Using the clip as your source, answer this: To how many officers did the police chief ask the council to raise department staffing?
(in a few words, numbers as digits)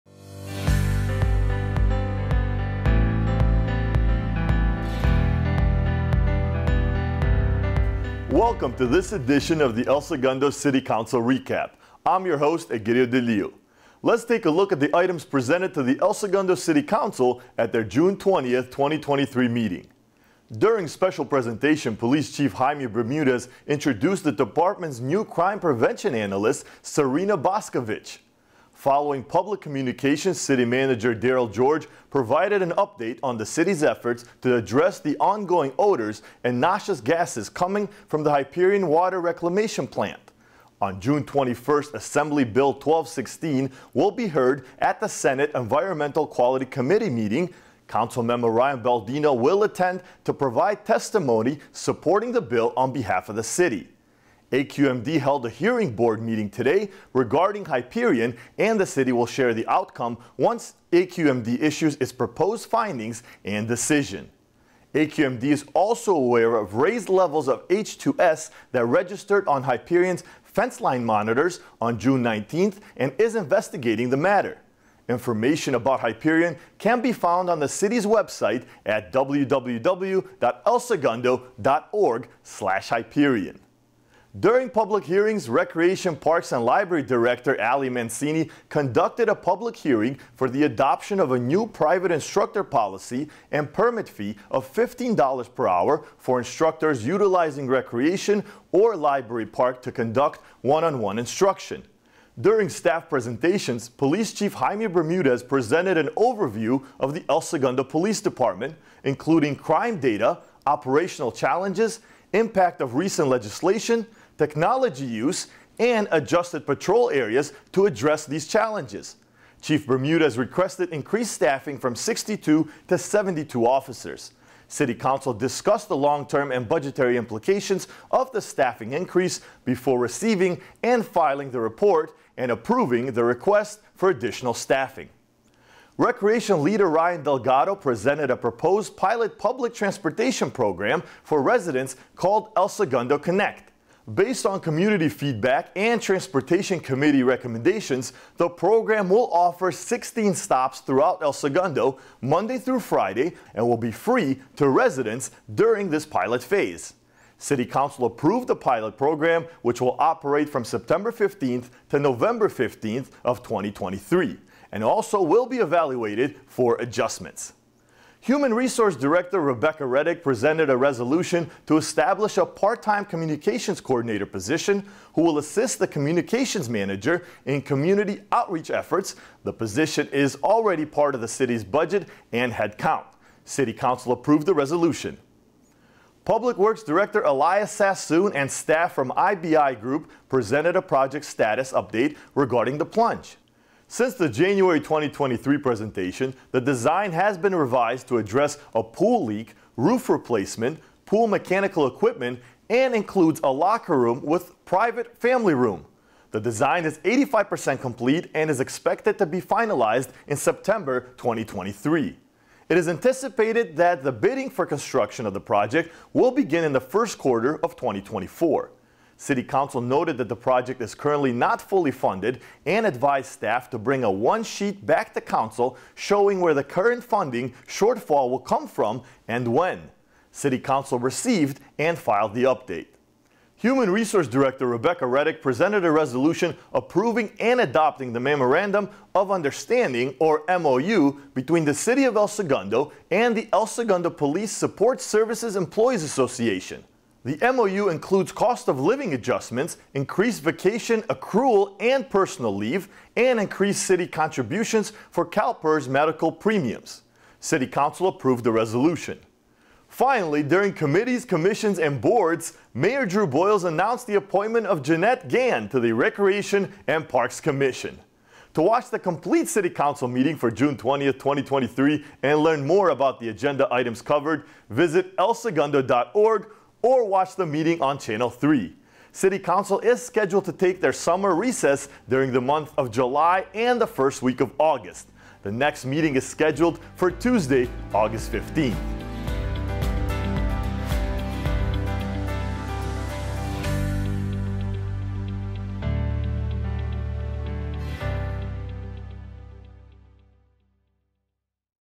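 72.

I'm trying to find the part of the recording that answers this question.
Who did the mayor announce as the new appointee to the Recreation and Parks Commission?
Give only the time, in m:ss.
4:24.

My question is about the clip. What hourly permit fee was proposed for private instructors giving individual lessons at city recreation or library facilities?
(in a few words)
$15.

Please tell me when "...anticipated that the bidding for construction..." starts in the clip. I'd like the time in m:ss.
3:32.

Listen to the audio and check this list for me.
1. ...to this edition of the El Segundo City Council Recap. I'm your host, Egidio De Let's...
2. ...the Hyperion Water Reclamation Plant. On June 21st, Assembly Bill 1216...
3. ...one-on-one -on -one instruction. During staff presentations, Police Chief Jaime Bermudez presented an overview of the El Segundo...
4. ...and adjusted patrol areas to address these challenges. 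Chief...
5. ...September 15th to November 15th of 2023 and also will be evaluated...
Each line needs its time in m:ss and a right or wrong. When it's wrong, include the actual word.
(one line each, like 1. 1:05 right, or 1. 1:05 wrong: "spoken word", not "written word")
1. 0:08 right
2. 0:38 right
3. 1:40 right
4. 1:55 right
5. 2:40 right.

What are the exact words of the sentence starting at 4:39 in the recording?
City Council is scheduled to take their summer recess during the month of July and the first week of August.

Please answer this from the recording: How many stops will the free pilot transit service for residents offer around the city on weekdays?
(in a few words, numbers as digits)
16.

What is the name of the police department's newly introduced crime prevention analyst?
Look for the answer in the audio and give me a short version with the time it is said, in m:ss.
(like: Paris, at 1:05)
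Serena Boscovich, at 0:26.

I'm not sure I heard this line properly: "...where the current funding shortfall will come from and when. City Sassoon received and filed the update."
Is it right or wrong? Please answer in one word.
wrong.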